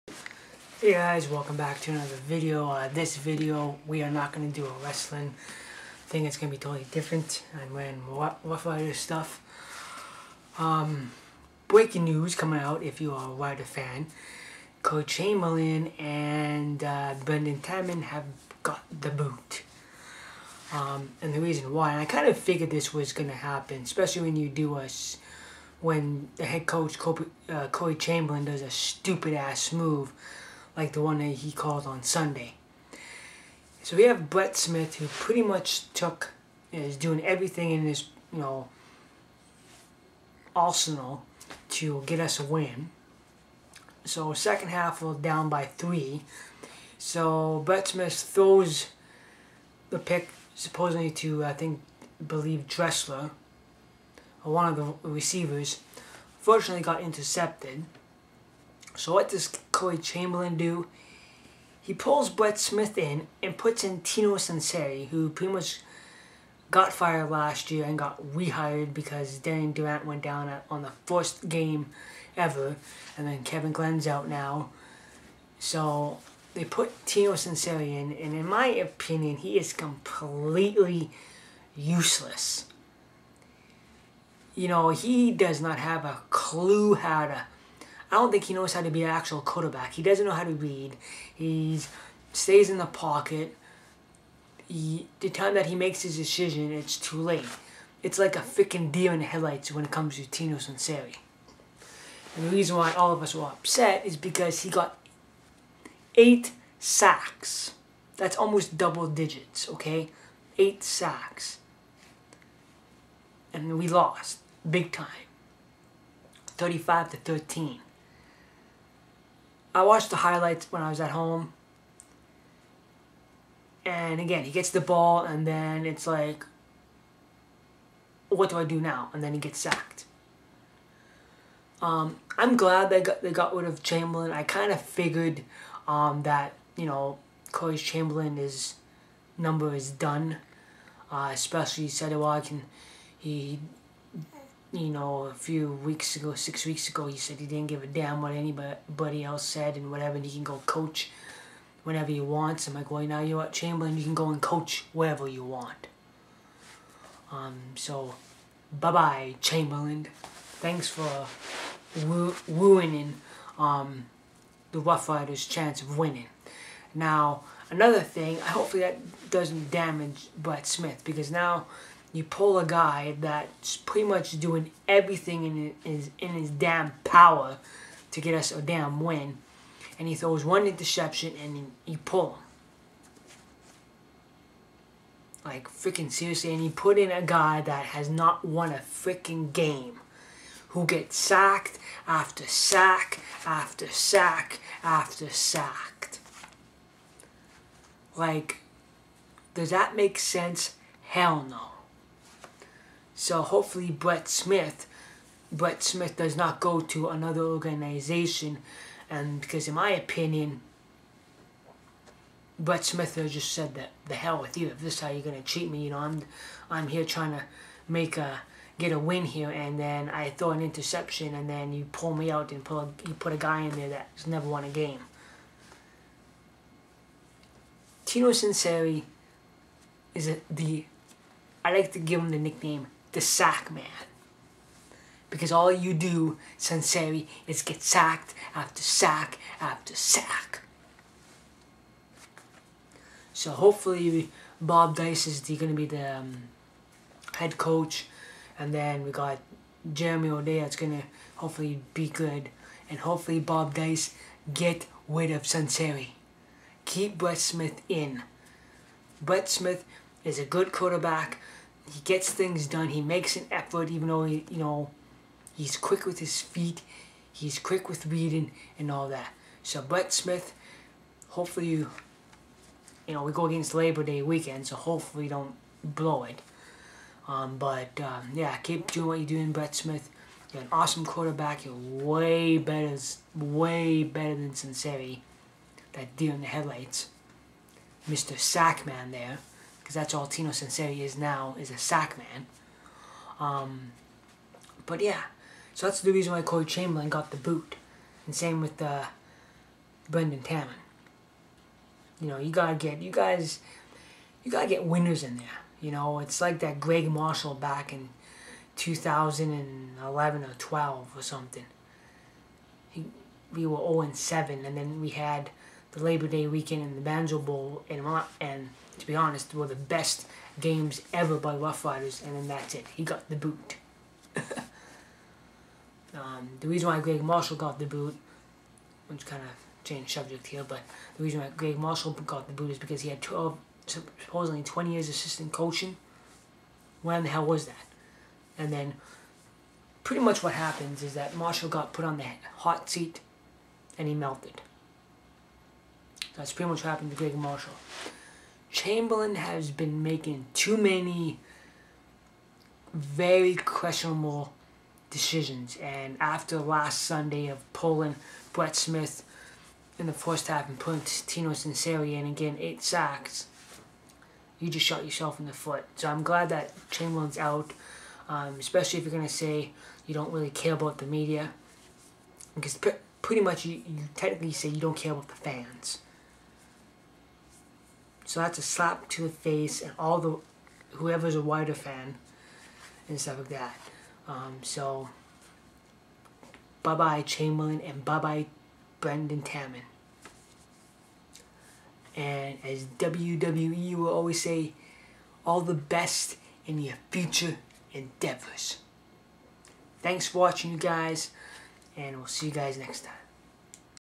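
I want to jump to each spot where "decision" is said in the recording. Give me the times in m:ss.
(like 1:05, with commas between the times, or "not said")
1:36, 5:55.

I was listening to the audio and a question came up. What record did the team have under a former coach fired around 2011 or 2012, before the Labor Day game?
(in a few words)
0 and 7.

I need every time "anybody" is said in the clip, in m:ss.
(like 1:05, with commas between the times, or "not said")
2:28.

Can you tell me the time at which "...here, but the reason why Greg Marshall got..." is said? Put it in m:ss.
5:30.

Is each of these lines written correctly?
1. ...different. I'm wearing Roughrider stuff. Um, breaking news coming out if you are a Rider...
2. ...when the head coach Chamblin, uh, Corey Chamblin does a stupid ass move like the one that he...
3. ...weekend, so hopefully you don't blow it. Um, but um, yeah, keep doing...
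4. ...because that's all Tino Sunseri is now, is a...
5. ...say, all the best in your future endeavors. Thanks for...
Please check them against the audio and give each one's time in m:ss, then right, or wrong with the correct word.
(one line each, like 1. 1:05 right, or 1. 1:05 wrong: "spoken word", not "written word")
1. 0:06 right
2. 0:25 wrong: "Kobe", not "Chamblin"
3. 4:34 right
4. 4:49 right
5. 6:34 right.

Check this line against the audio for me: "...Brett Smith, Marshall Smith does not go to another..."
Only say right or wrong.
wrong.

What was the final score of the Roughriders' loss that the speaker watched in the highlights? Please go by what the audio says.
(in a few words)
35 to 13.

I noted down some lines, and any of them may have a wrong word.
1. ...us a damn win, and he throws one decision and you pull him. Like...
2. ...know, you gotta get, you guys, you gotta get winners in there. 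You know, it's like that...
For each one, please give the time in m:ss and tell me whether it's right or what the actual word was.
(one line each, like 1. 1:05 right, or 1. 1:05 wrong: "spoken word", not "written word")
1. 2:58 wrong: "interception", not "decision"
2. 5:02 right.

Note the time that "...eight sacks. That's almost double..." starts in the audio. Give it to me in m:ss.
1:46.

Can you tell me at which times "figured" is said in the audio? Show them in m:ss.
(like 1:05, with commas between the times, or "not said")
0:22, 2:14.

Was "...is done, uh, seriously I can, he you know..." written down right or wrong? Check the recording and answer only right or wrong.
wrong.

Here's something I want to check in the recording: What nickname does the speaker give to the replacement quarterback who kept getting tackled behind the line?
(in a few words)
The Sack Man.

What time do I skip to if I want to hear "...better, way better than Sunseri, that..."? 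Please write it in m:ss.
4:42.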